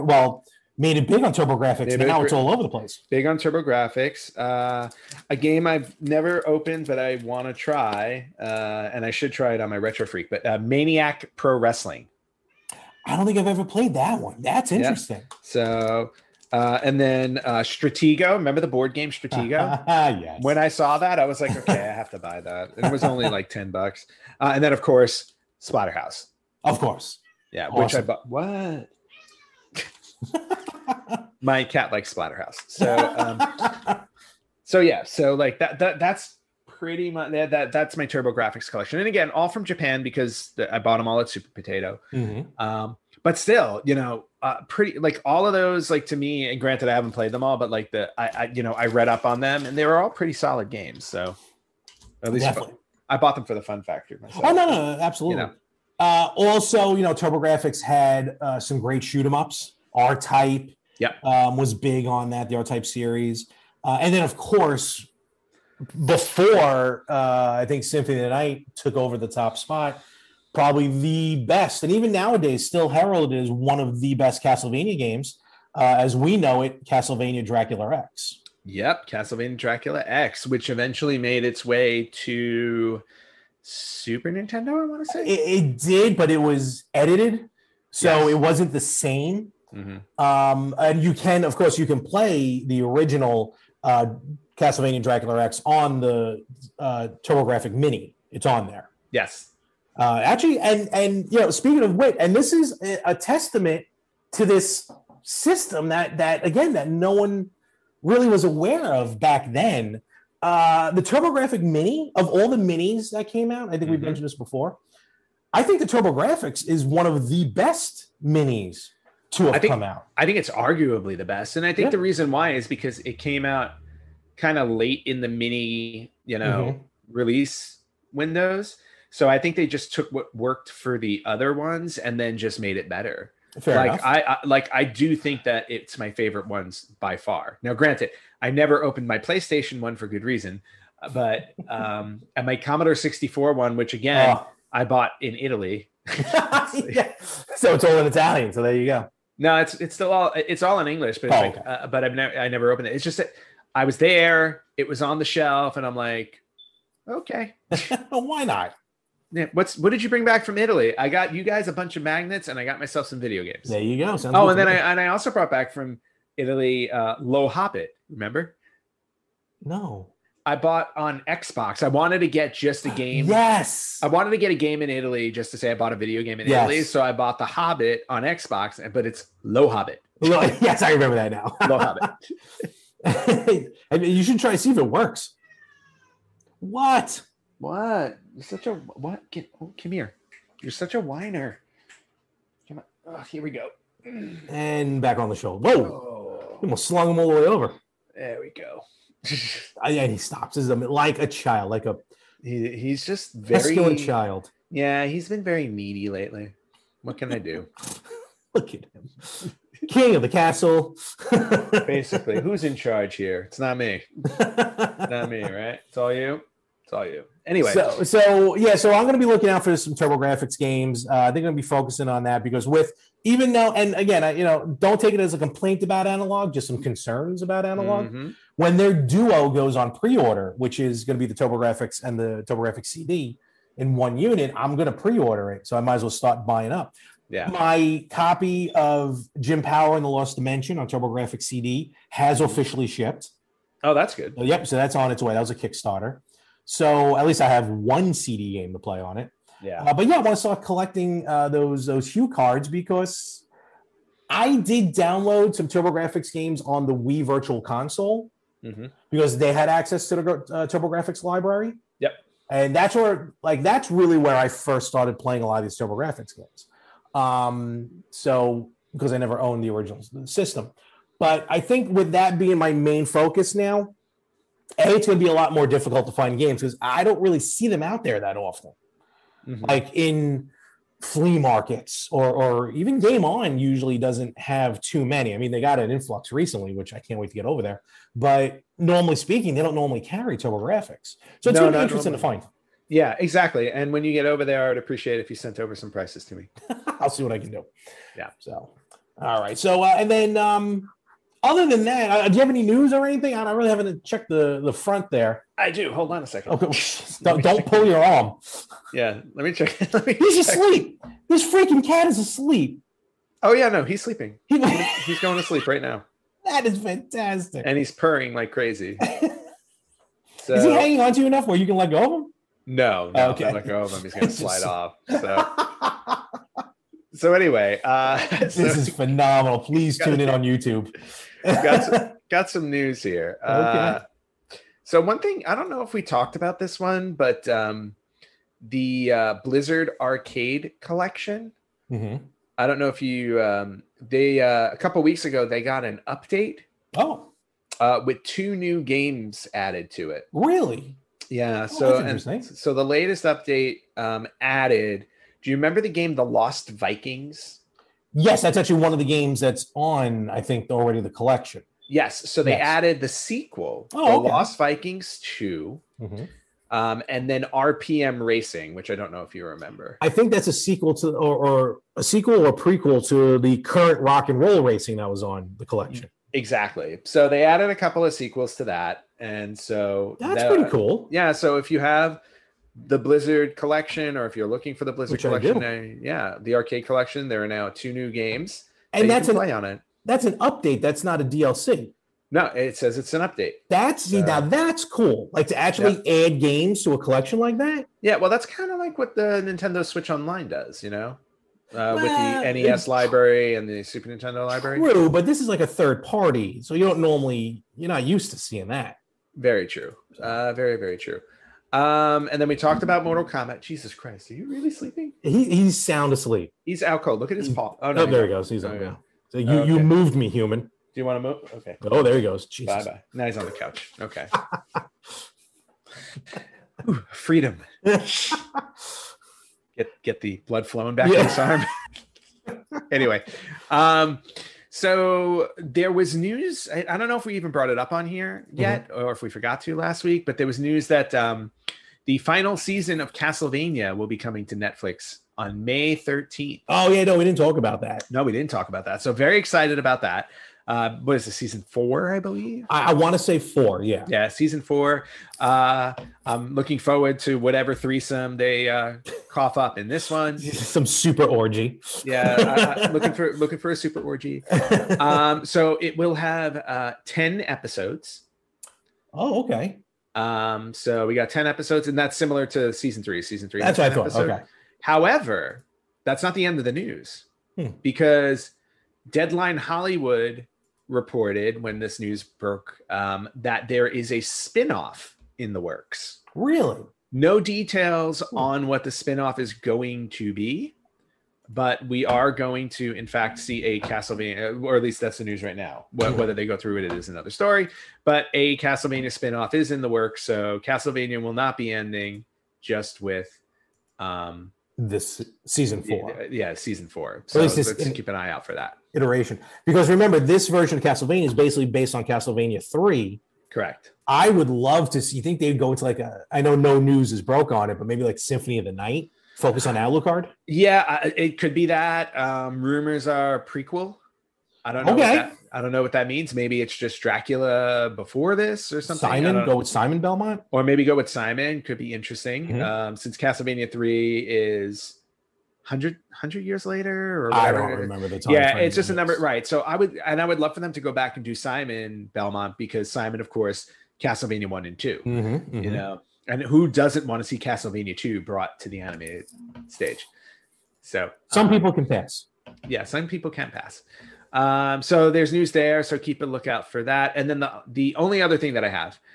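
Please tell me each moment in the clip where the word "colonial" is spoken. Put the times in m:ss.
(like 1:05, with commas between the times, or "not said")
not said.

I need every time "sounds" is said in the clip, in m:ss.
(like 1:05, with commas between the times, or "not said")
2:44, 6:55.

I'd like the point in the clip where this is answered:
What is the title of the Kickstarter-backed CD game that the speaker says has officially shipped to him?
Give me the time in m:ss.
3:59.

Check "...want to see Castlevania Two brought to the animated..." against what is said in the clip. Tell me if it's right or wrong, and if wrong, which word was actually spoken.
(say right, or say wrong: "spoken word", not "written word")
right.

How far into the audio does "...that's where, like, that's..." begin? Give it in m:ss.
4:22.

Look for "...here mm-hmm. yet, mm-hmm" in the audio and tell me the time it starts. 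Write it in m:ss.
7:18.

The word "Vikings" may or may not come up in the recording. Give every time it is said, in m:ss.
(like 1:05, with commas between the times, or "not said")
5:56, 6:04.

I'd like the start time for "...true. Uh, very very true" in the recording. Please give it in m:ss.
6:49.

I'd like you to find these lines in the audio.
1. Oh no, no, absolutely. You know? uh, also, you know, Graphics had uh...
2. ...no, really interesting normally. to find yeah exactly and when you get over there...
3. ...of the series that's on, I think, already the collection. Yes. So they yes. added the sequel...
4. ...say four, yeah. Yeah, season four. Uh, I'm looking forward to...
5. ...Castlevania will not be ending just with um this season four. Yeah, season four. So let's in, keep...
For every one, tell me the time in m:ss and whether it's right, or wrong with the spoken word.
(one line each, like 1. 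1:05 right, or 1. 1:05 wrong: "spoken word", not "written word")
1. 0:54 right
2. 4:51 right
3. 5:58 wrong: "games", not "series"
4. 7:33 right
5. 8:20 right.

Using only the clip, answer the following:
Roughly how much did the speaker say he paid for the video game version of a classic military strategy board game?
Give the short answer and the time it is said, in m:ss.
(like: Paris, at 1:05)
10 bucks, at 0:23.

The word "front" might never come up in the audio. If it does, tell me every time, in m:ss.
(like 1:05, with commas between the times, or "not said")
5:04.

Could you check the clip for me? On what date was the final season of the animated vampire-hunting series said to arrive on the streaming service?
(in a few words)
May 13th.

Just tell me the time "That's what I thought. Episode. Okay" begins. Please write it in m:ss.
7:53.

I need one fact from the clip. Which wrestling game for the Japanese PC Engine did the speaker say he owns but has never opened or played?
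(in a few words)
Maniac Pro Wrestling.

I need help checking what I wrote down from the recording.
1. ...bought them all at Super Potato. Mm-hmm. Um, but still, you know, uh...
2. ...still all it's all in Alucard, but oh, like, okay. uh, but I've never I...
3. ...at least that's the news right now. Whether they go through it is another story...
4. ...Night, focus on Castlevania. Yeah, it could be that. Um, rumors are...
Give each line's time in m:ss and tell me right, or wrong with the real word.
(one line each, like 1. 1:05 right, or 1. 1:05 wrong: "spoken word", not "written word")
1. 0:40 right
2. 2:29 wrong: "English", not "Alucard"
3. 8:14 right
4. 8:38 wrong: "Alucard", not "Castlevania".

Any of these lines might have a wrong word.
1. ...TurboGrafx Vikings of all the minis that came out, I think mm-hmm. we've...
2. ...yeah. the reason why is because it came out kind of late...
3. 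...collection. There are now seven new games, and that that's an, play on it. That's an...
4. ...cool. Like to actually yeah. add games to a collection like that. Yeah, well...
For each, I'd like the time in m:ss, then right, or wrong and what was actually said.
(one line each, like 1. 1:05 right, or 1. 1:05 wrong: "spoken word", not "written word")
1. 1:51 wrong: "Mini", not "Vikings"
2. 2:01 right
3. 6:26 wrong: "two", not "seven"
4. 6:34 right.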